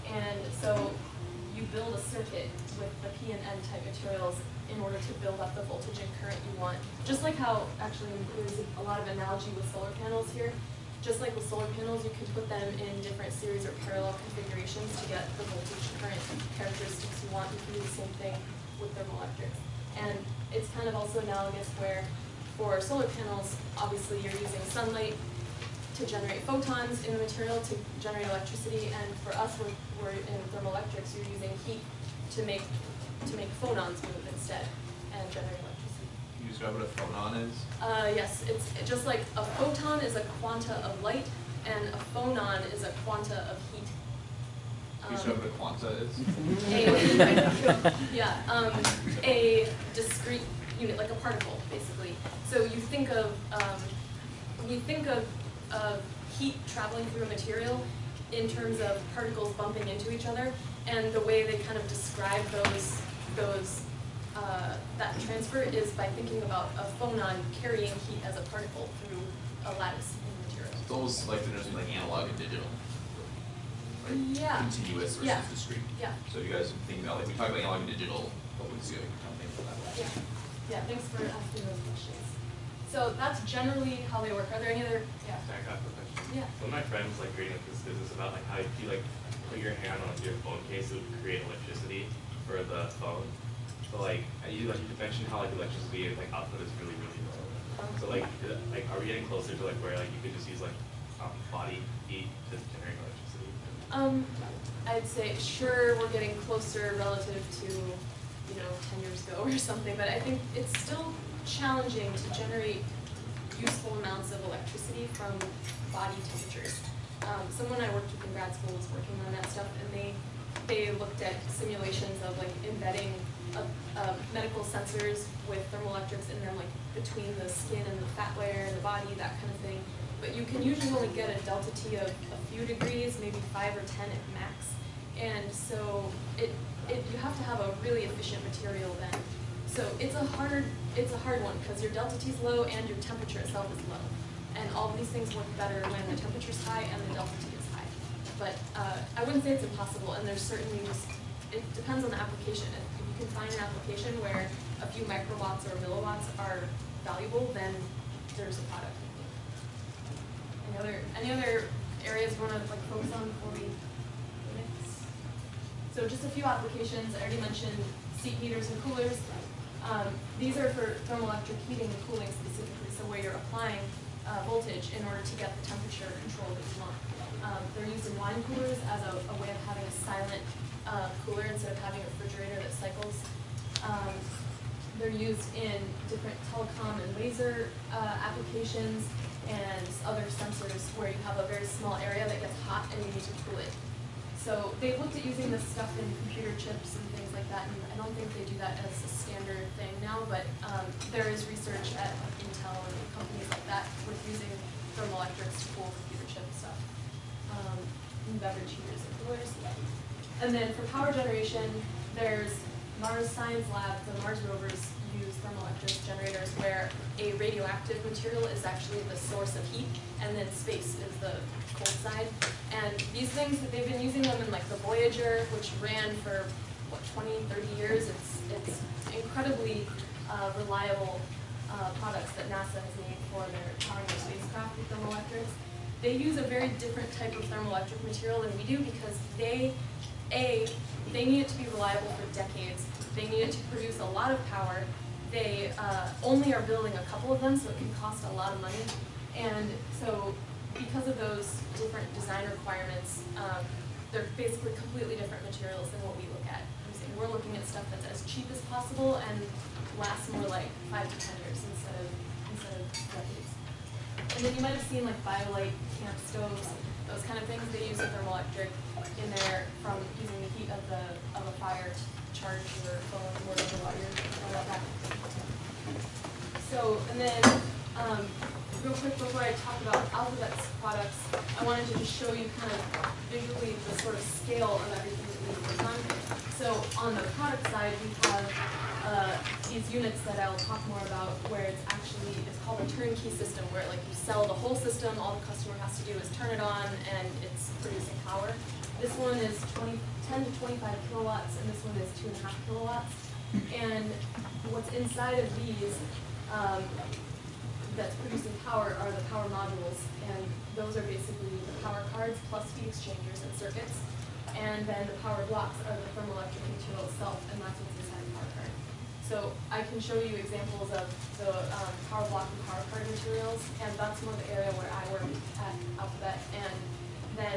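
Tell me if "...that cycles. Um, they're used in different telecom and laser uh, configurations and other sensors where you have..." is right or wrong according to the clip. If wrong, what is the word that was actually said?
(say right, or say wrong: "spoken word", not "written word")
wrong: "applications", not "configurations".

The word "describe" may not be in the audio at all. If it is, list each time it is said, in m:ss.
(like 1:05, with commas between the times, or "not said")
0:36, 1:01.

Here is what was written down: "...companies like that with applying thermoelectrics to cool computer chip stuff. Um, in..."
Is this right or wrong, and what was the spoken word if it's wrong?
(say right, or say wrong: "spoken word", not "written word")
wrong: "using", not "applying".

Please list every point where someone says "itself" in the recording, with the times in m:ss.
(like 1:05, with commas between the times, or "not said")
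2:23, 5:17.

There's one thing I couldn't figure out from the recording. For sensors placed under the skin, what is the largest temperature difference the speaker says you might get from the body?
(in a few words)
10 degrees.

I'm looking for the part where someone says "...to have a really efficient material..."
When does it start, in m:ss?
2:17.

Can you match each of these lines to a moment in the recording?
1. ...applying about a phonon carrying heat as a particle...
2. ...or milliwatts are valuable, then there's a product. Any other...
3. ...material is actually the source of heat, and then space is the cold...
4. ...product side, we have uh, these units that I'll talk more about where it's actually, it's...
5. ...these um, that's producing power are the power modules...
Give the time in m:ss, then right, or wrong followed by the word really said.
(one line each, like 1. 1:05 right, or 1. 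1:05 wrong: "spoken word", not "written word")
1. 1:06 wrong: "thinking", not "applying"
2. 2:35 right
3. 3:38 right
4. 4:47 right
5. 5:05 right.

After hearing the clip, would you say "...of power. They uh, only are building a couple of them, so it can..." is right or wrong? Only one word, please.
right.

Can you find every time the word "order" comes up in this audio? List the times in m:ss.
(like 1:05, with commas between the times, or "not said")
0:04, 2:55.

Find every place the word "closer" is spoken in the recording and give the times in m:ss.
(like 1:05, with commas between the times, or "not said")
1:39, 1:46.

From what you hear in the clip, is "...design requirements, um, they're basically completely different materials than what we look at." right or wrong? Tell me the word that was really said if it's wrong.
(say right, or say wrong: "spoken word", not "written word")
right.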